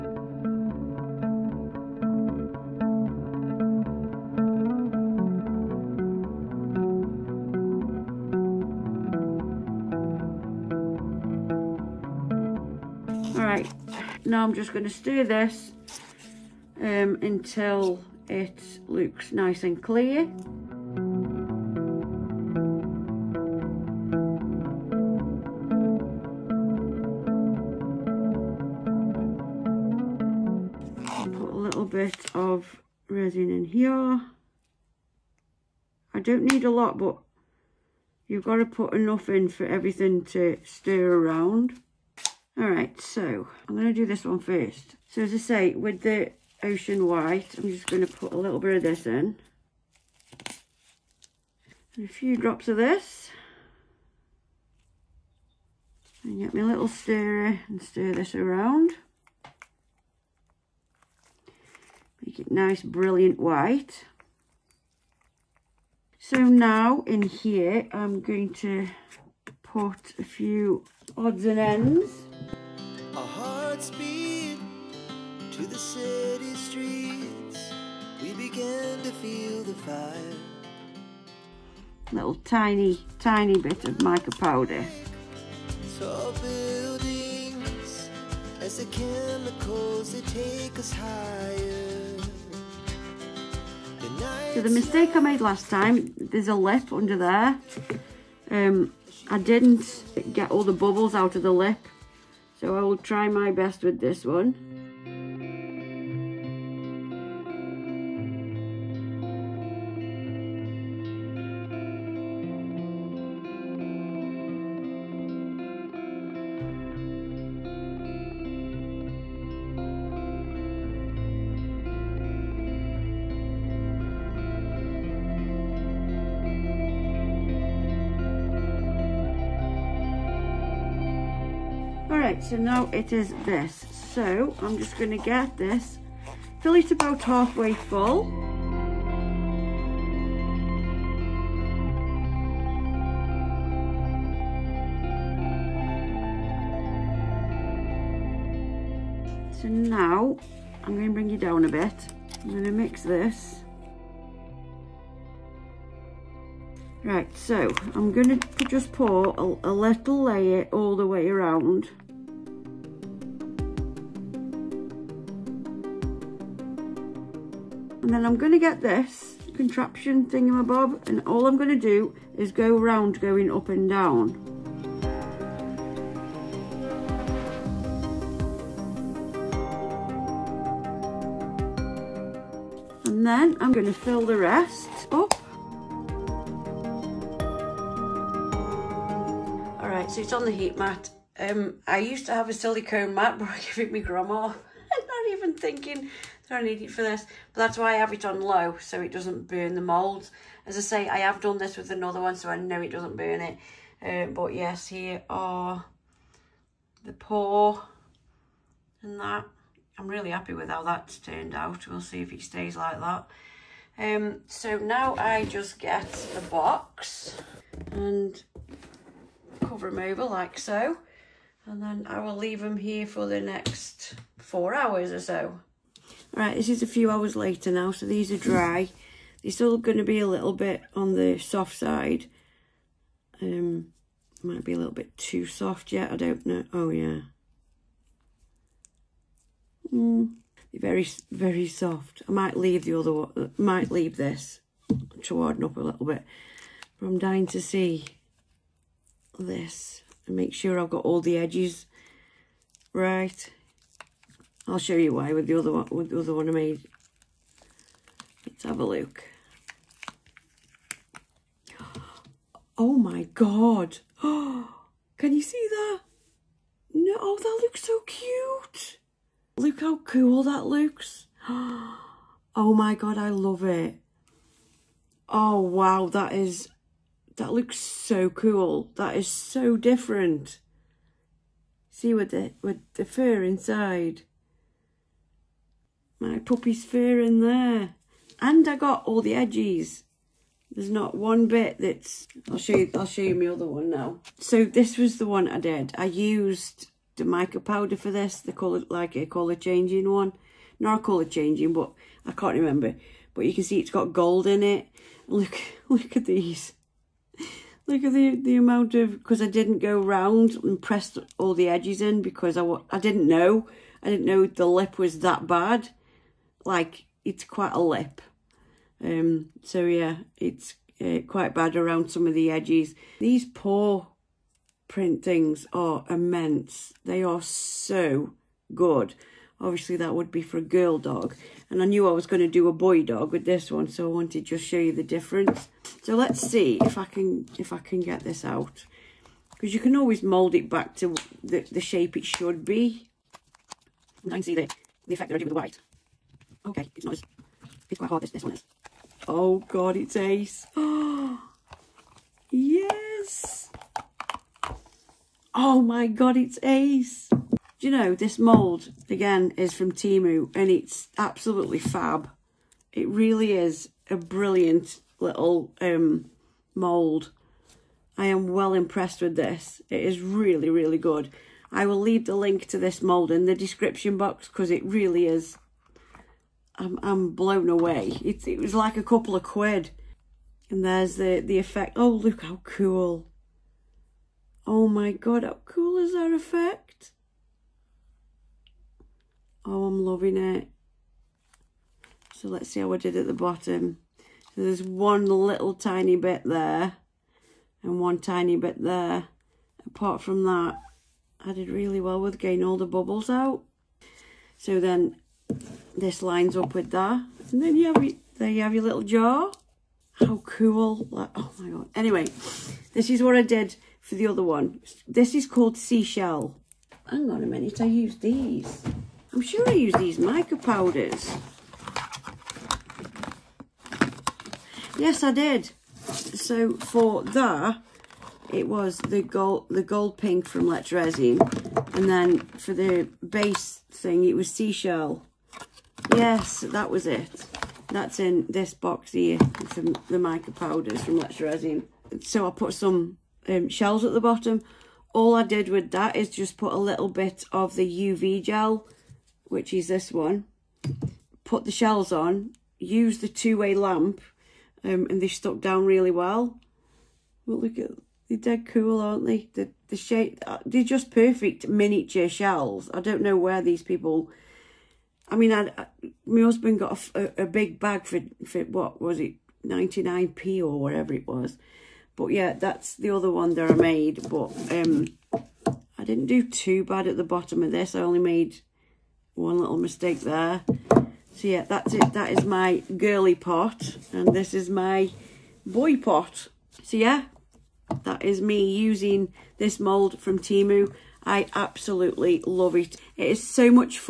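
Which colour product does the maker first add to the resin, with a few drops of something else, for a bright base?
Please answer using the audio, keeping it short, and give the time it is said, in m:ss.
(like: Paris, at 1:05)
Ocean white, at 0:46.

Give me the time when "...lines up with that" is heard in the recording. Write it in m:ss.
6:46.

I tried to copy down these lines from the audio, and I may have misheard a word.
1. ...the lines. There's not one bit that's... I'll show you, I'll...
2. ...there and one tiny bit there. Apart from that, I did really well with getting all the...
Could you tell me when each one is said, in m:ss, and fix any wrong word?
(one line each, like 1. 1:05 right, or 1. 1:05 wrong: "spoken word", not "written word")
1. 4:49 wrong: "edges", not "lines"
2. 6:36 right.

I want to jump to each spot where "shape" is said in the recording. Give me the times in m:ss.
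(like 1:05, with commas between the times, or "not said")
5:41, 7:39.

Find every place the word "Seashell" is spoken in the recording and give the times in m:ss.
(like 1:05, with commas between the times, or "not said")
6:55, 7:14.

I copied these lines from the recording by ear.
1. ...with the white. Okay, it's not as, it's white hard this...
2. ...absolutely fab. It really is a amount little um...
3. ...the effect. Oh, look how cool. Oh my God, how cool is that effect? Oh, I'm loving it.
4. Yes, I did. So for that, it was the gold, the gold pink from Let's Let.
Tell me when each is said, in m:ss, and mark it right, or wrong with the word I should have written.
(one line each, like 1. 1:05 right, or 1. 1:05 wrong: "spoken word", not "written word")
1. 5:45 wrong: "quite", not "white"
2. 6:01 wrong: "brilliant", not "amount"
3. 6:21 right
4. 7:04 wrong: "Resin", not "Let".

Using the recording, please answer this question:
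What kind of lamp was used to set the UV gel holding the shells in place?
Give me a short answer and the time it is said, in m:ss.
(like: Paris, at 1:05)
Two-way lamp, at 7:33.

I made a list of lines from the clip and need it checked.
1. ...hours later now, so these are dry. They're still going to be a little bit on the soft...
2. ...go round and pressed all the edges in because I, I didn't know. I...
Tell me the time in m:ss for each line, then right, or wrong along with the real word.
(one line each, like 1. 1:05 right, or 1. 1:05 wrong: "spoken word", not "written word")
1. 3:47 right
2. 5:09 right.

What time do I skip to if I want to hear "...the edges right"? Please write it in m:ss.
4:11.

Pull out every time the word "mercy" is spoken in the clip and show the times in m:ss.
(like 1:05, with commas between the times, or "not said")
not said.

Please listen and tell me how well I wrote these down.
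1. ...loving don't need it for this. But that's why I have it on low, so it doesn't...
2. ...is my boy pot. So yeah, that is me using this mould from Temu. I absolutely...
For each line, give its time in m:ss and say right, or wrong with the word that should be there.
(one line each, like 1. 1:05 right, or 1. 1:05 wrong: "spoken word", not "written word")
1. 3:15 wrong: "thinking", not "loving"
2. 8:04 right.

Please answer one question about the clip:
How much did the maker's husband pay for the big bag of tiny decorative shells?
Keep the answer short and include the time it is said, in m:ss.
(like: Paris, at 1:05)
99p, at 7:49.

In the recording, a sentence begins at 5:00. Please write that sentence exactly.
Not a colour changing, but I can't remember.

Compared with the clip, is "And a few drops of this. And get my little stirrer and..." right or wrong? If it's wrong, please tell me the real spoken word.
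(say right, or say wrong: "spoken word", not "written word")
right.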